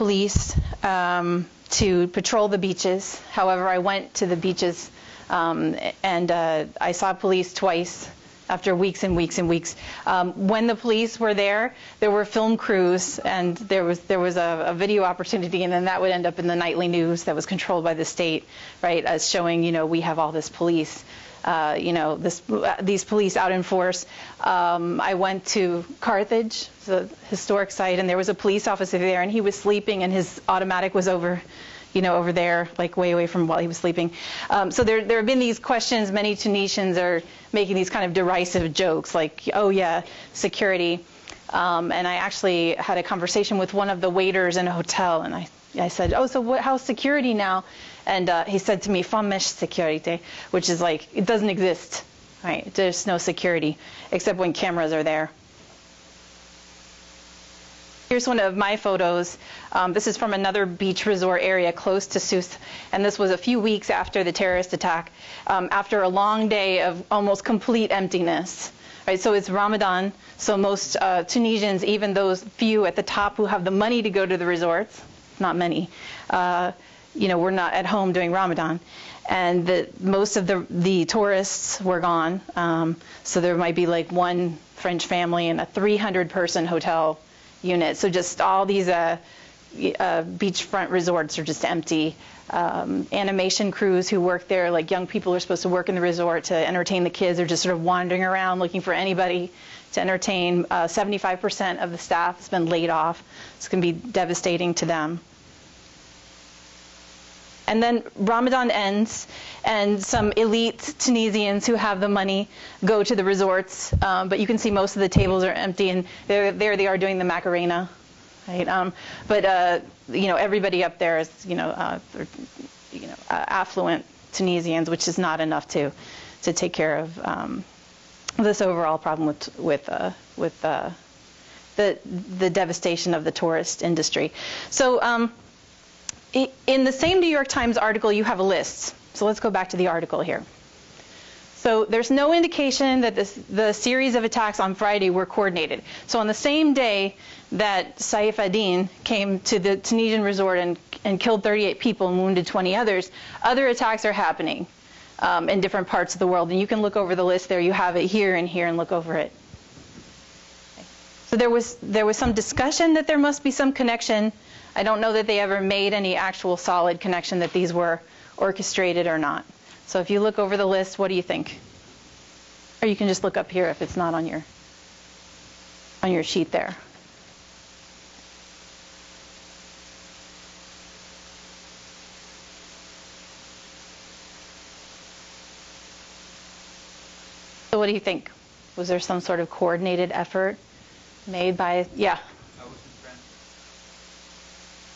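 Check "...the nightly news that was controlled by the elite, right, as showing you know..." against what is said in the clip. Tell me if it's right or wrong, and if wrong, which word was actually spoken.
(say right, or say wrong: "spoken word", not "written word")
wrong: "state", not "elite".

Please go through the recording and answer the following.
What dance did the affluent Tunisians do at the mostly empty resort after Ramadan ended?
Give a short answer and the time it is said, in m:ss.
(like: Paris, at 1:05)
Macarena, at 1:57.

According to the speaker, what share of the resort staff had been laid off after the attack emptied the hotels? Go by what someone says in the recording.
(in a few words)
75%.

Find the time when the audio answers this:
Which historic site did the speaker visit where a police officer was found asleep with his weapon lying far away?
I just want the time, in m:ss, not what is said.
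0:25.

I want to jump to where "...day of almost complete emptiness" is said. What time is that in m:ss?
1:06.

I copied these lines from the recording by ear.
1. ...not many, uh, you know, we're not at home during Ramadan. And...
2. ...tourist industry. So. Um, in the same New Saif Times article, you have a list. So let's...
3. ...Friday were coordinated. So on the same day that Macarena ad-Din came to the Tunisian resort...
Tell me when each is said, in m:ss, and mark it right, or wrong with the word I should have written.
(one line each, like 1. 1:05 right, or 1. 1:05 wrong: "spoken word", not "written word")
1. 1:15 right
2. 2:13 wrong: "York", not "Saif"
3. 2:24 wrong: "Saif", not "Macarena".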